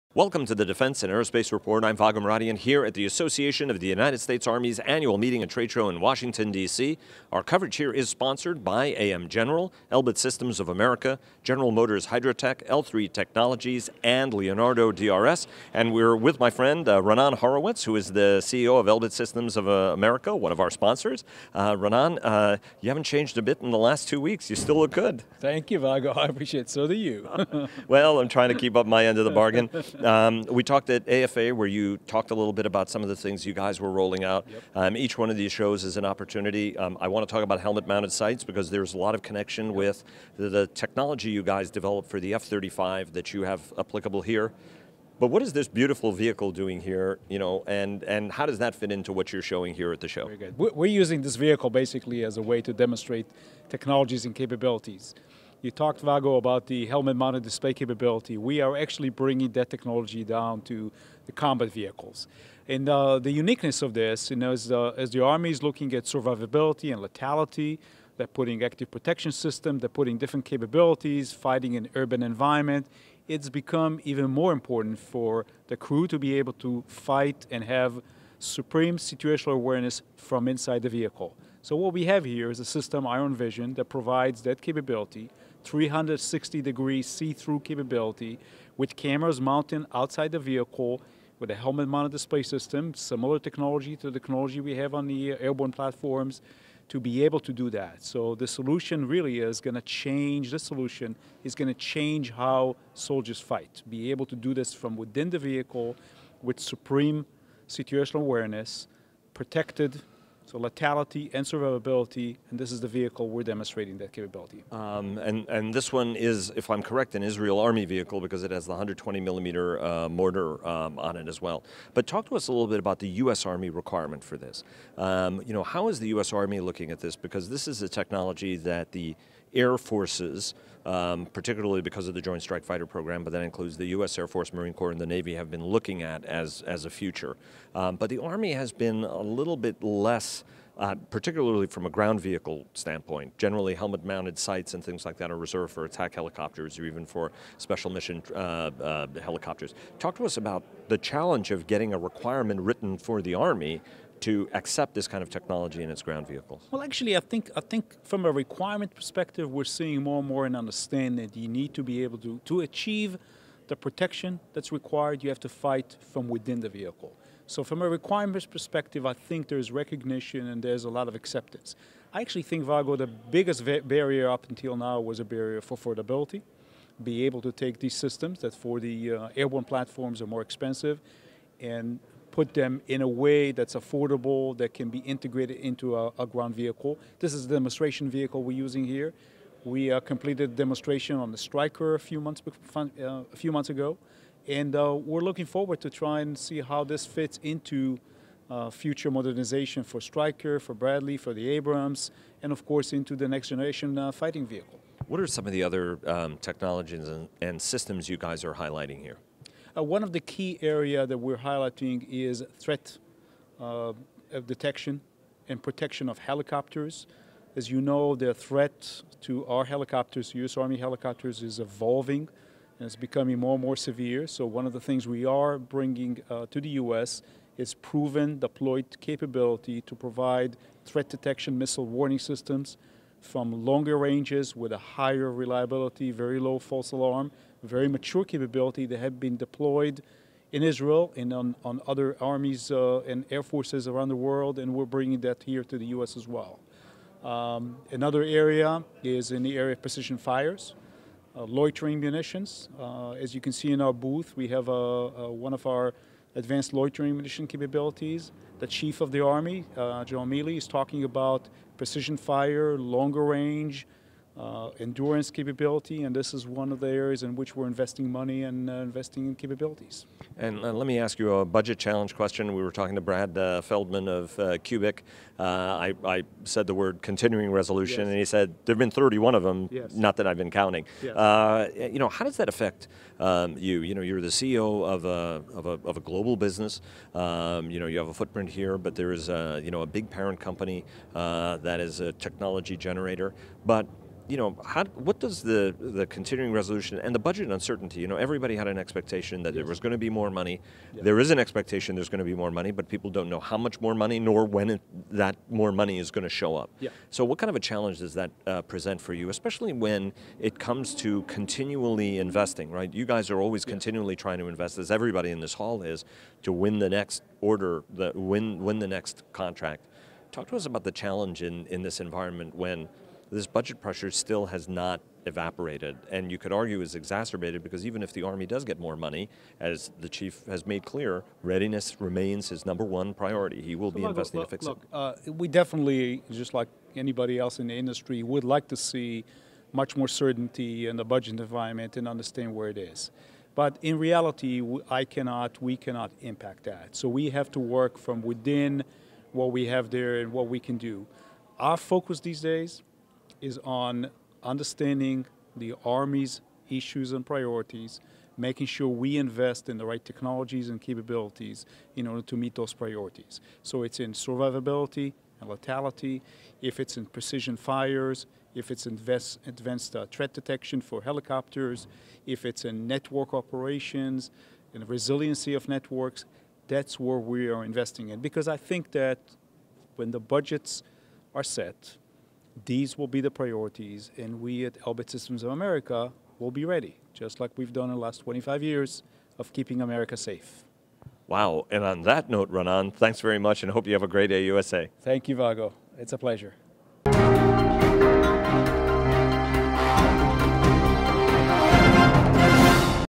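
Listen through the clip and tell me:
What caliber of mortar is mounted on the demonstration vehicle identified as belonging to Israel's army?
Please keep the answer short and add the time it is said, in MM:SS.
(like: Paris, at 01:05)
120 millimeter, at 01:58.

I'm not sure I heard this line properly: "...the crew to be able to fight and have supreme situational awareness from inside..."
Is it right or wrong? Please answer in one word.
right.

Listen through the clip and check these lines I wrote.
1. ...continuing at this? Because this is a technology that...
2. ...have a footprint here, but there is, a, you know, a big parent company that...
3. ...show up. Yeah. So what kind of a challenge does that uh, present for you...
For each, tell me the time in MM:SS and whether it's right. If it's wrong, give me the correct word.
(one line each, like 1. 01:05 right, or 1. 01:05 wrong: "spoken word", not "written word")
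1. 02:06 wrong: "looking", not "continuing"
2. 04:47 right
3. 05:06 right.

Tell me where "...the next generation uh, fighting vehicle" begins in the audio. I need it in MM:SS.
03:23.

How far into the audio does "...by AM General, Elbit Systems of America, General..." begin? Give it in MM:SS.
00:08.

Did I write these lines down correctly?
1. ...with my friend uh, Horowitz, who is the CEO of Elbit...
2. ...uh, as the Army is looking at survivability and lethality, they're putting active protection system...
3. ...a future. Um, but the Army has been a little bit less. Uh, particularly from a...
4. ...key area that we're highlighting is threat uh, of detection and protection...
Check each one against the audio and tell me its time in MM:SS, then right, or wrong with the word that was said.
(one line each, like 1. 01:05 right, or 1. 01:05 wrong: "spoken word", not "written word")
1. 00:16 right
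2. 01:04 right
3. 02:16 right
4. 03:30 right.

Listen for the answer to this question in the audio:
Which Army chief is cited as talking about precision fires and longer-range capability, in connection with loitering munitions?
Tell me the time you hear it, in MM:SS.
04:20.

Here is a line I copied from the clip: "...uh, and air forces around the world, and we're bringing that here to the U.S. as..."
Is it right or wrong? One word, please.
right.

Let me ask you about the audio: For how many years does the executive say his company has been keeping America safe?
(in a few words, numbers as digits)
25 years.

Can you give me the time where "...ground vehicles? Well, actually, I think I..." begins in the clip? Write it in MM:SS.
02:36.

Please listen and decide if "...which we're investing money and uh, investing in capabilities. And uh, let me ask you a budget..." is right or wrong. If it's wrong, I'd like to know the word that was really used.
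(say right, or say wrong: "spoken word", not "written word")
right.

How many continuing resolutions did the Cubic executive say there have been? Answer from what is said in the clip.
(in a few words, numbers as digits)
31.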